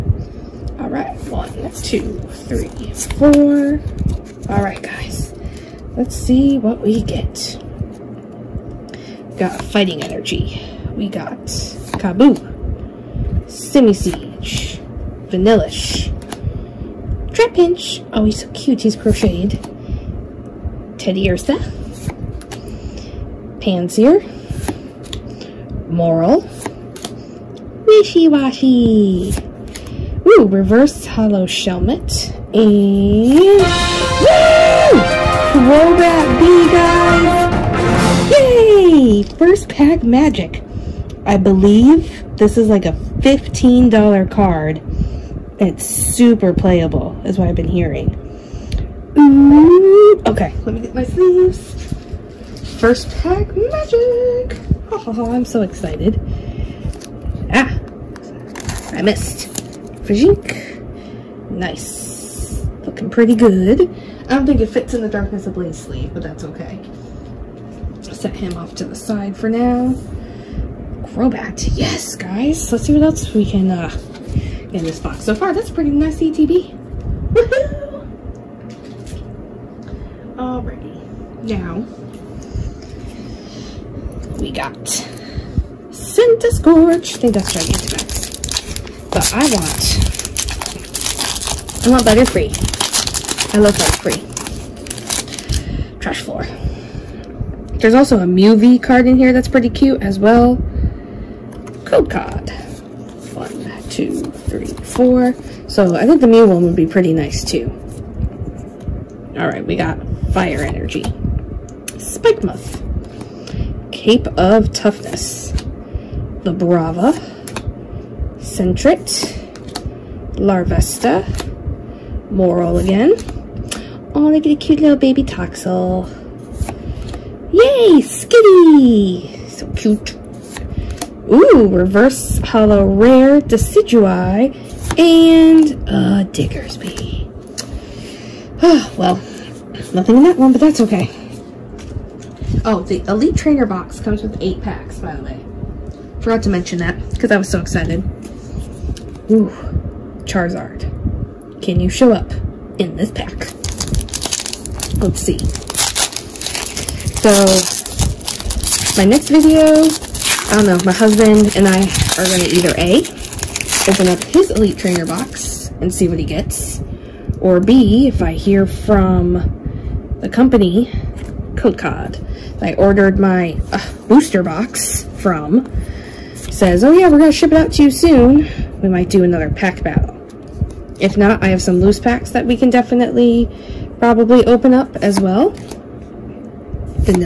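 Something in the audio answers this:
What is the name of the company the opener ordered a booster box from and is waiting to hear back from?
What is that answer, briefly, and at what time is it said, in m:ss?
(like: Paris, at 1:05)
Code Cod, at 2:51.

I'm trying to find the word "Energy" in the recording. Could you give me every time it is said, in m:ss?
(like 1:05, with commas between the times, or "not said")
0:10, 1:50.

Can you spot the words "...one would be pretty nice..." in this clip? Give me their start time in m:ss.
1:46.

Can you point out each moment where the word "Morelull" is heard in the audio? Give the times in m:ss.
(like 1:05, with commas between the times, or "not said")
0:25, 2:02.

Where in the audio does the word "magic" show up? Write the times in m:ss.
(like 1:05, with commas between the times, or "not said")
0:40, 0:53.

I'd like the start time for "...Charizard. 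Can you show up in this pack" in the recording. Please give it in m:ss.
2:30.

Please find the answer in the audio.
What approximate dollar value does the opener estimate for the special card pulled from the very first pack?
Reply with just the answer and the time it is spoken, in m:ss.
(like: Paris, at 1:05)
$15, at 0:42.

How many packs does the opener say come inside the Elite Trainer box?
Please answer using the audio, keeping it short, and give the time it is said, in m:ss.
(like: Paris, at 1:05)
8, at 2:24.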